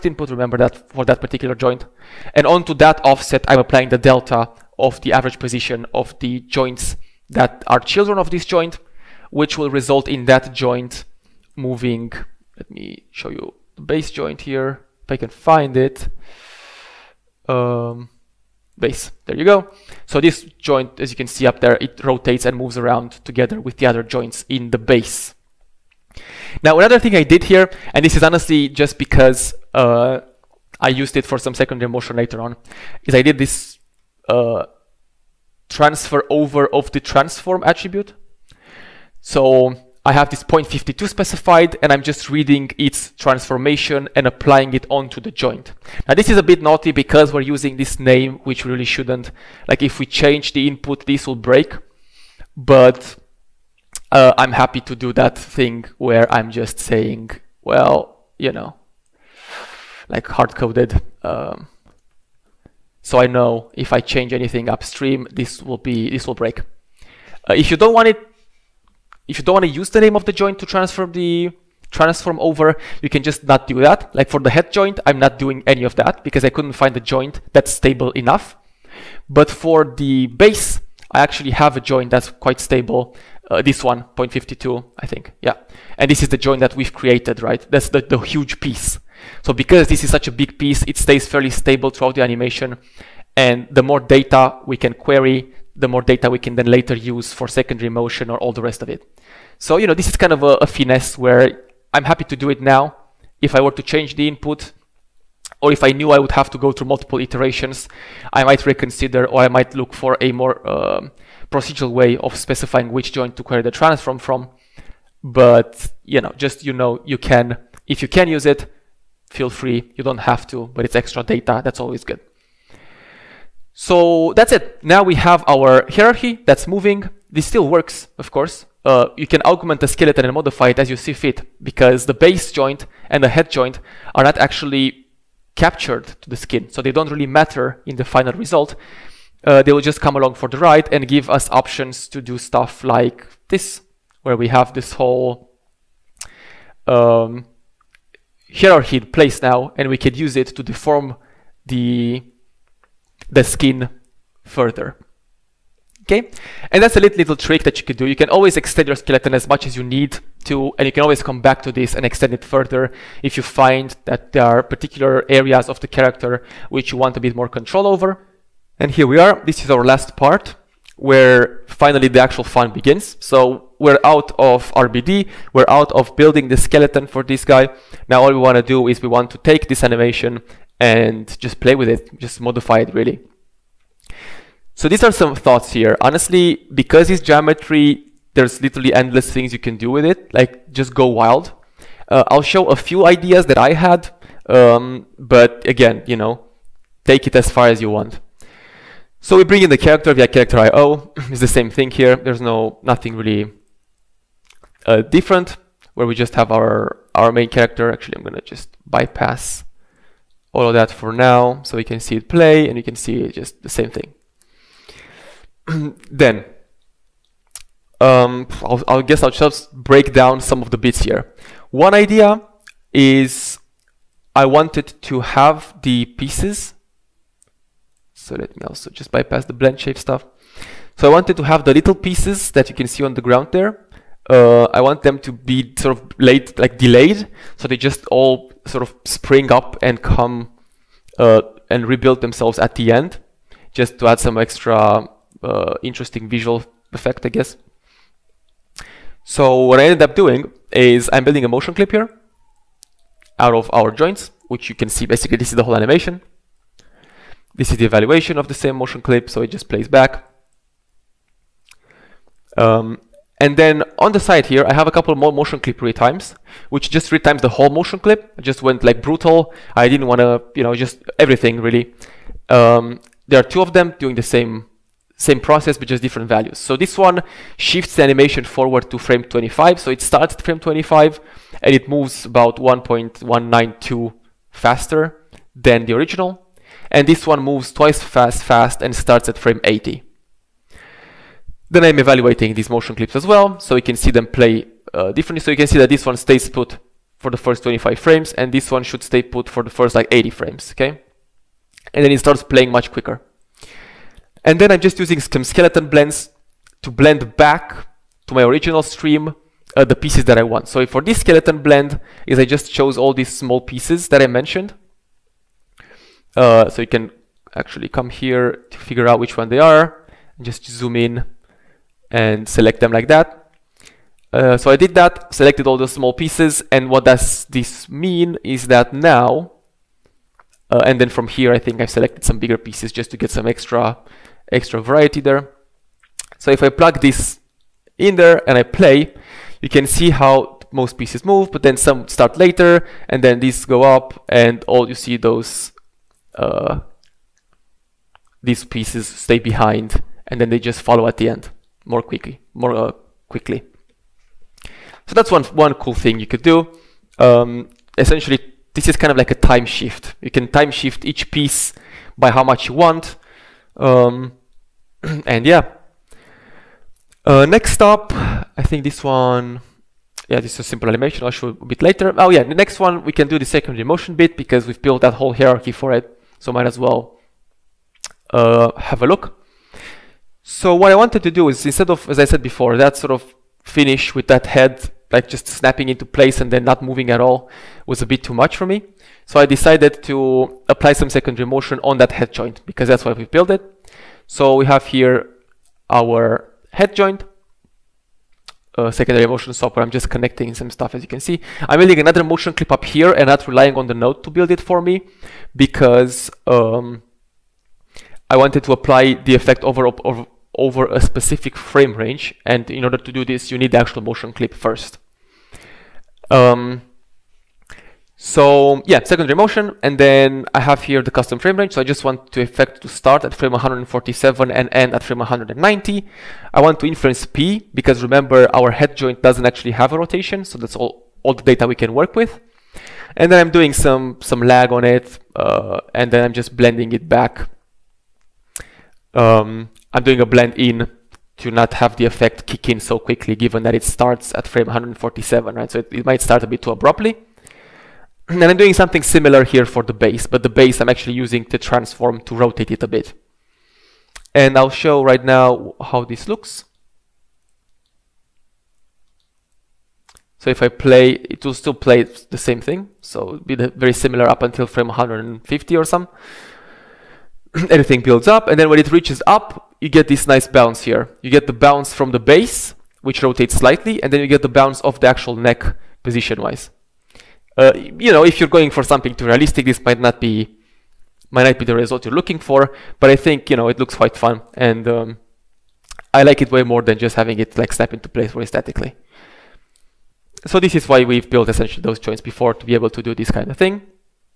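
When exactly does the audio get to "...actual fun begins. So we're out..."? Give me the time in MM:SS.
02:52.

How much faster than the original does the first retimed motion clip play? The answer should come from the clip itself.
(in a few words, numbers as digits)
1.192.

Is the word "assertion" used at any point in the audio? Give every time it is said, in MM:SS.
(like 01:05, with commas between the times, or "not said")
not said.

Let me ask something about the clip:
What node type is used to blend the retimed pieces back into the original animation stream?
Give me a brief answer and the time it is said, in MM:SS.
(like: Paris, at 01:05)
skeleton blends, at 05:05.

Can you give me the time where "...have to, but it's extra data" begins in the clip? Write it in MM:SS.
02:00.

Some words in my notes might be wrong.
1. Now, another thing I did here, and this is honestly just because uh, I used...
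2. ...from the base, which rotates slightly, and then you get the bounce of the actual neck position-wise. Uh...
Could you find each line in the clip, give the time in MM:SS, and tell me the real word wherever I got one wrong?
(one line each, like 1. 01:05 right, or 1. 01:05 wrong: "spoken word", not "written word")
1. 00:26 right
2. 07:51 right.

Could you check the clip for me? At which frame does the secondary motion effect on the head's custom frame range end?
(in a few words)
190.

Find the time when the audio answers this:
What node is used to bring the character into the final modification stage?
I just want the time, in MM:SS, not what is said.
03:20.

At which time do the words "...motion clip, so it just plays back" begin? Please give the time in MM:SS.
04:18.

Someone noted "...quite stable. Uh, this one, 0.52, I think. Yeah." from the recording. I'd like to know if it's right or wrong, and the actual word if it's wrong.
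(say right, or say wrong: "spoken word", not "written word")
right.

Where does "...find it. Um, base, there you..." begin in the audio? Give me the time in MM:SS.
00:15.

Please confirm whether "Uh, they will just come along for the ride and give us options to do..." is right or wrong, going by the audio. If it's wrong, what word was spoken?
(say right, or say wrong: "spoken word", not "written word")
right.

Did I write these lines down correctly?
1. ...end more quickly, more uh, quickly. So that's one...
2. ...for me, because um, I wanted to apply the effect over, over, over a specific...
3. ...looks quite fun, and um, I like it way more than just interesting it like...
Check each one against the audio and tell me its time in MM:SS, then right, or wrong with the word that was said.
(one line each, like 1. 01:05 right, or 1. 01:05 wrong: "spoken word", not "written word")
1. 05:51 right
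2. 06:44 right
3. 08:03 wrong: "having", not "interesting".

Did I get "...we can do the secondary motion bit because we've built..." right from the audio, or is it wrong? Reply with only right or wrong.
right.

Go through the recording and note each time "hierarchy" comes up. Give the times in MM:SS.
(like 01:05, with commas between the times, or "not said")
02:05, 02:28, 06:15.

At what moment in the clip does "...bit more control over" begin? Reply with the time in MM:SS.
02:47.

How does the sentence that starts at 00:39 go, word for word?
So I have this 0.52 specified and I'm just reading its transformation and applying it onto the joint.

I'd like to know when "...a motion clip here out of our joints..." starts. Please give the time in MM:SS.
04:11.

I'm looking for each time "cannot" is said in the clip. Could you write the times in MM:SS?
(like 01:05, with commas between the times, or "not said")
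not said.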